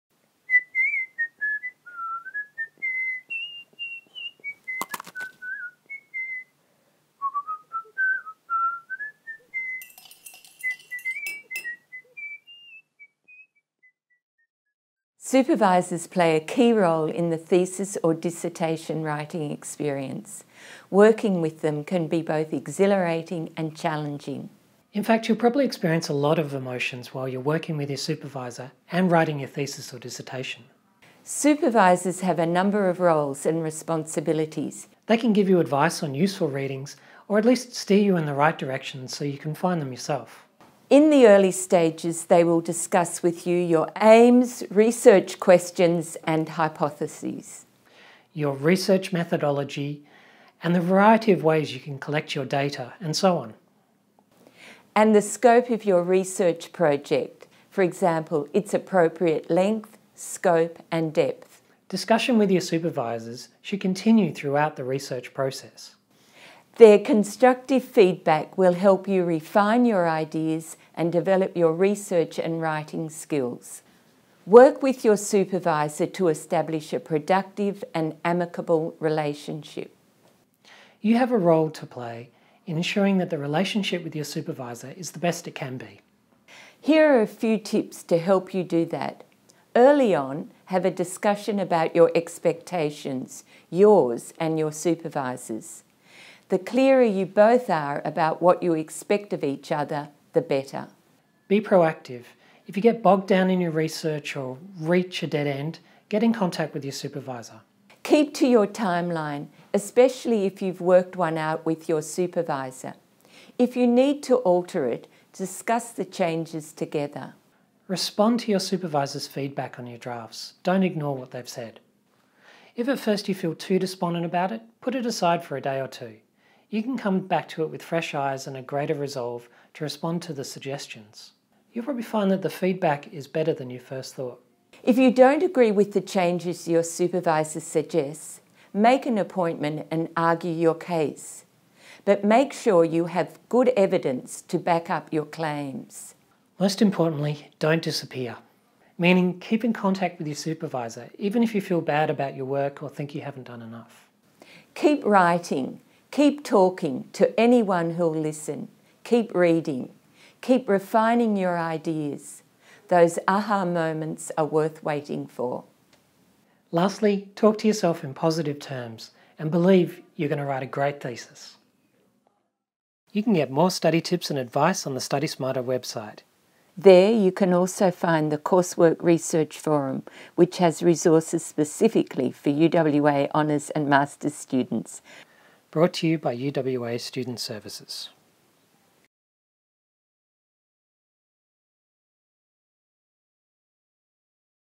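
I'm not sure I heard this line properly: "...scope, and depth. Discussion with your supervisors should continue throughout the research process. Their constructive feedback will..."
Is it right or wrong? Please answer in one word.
right.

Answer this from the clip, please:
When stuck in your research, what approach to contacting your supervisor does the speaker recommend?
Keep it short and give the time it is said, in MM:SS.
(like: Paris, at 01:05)
Be proactive, at 01:41.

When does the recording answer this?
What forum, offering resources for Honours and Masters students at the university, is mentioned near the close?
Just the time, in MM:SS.
02:58.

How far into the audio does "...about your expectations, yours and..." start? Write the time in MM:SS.
01:31.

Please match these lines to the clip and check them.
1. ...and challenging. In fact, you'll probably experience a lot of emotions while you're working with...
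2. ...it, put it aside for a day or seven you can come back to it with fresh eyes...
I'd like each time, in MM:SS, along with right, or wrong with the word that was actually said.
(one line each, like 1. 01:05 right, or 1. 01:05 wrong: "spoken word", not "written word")
1. 00:23 right
2. 02:04 wrong: "two", not "seven".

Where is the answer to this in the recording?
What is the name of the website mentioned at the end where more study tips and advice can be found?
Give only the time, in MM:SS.
02:55.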